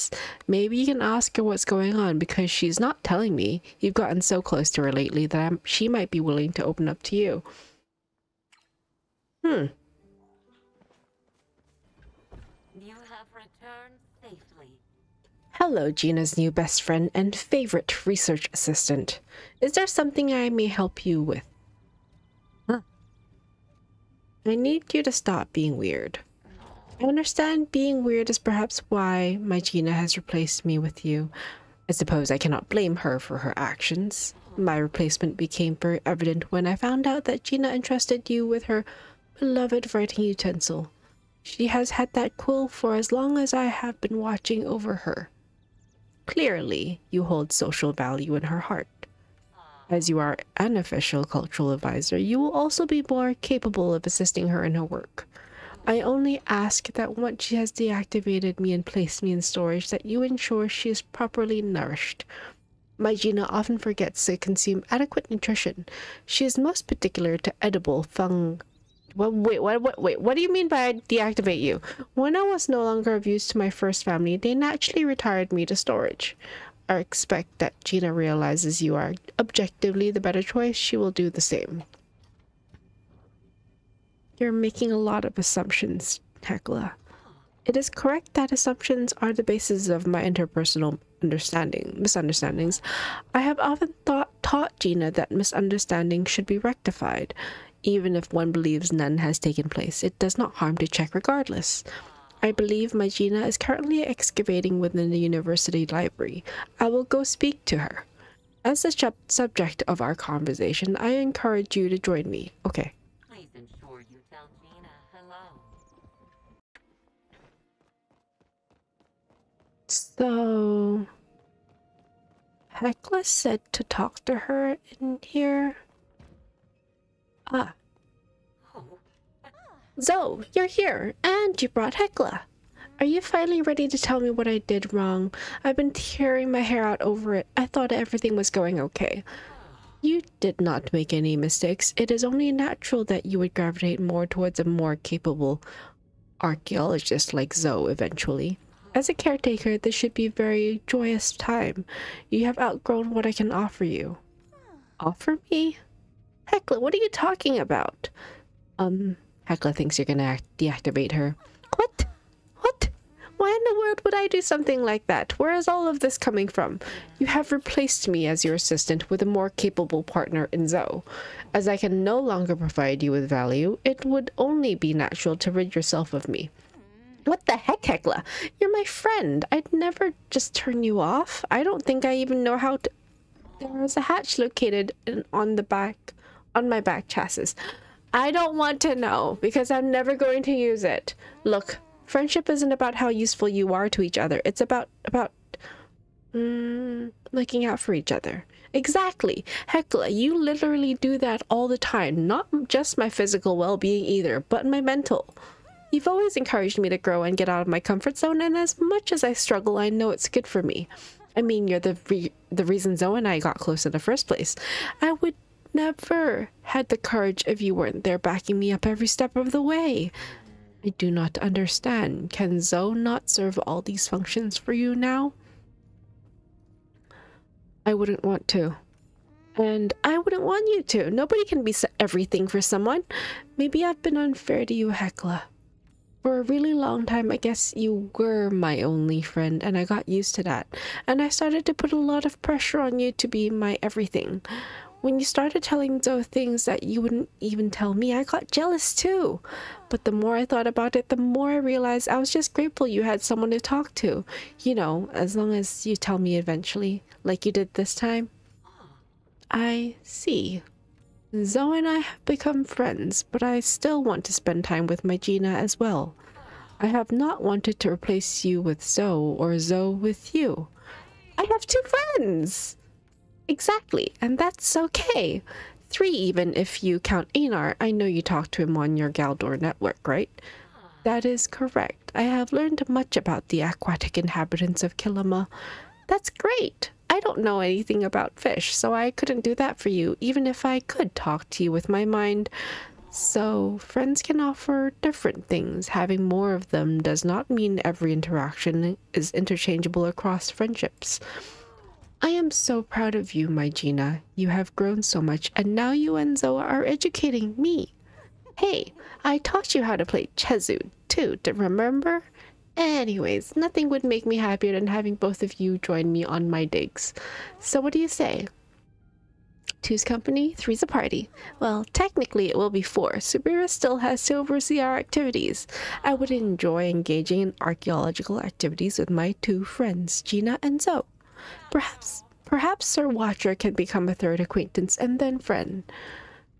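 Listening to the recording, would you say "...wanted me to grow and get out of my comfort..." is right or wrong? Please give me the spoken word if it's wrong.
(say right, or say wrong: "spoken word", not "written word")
wrong: "encouraged", not "wanted".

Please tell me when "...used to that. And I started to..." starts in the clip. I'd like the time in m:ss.
4:00.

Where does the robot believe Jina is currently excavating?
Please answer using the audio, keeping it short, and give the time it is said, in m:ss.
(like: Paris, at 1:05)
The university library, at 1:45.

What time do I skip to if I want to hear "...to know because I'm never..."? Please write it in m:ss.
3:08.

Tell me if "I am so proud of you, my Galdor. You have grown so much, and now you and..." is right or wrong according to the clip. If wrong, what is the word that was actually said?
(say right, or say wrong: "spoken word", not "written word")
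wrong: "Jina", not "Galdor".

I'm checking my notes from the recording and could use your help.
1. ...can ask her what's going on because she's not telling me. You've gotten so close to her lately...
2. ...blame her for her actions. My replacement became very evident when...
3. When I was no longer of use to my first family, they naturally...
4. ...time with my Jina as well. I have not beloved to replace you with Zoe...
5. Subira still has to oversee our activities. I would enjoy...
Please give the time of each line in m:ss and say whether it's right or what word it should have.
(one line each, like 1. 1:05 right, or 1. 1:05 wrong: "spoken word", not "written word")
1. 0:00 right
2. 0:32 right
3. 1:12 right
4. 4:24 wrong: "wanted", not "beloved"
5. 5:23 right.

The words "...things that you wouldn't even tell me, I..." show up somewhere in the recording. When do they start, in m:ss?
4:06.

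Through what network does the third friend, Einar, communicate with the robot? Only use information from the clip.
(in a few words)
Galdor network.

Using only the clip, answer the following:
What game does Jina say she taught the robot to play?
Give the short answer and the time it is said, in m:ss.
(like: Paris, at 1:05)
Chezu, at 5:10.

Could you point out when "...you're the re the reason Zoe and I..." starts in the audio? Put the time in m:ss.
3:31.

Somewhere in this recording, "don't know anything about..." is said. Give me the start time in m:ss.
4:47.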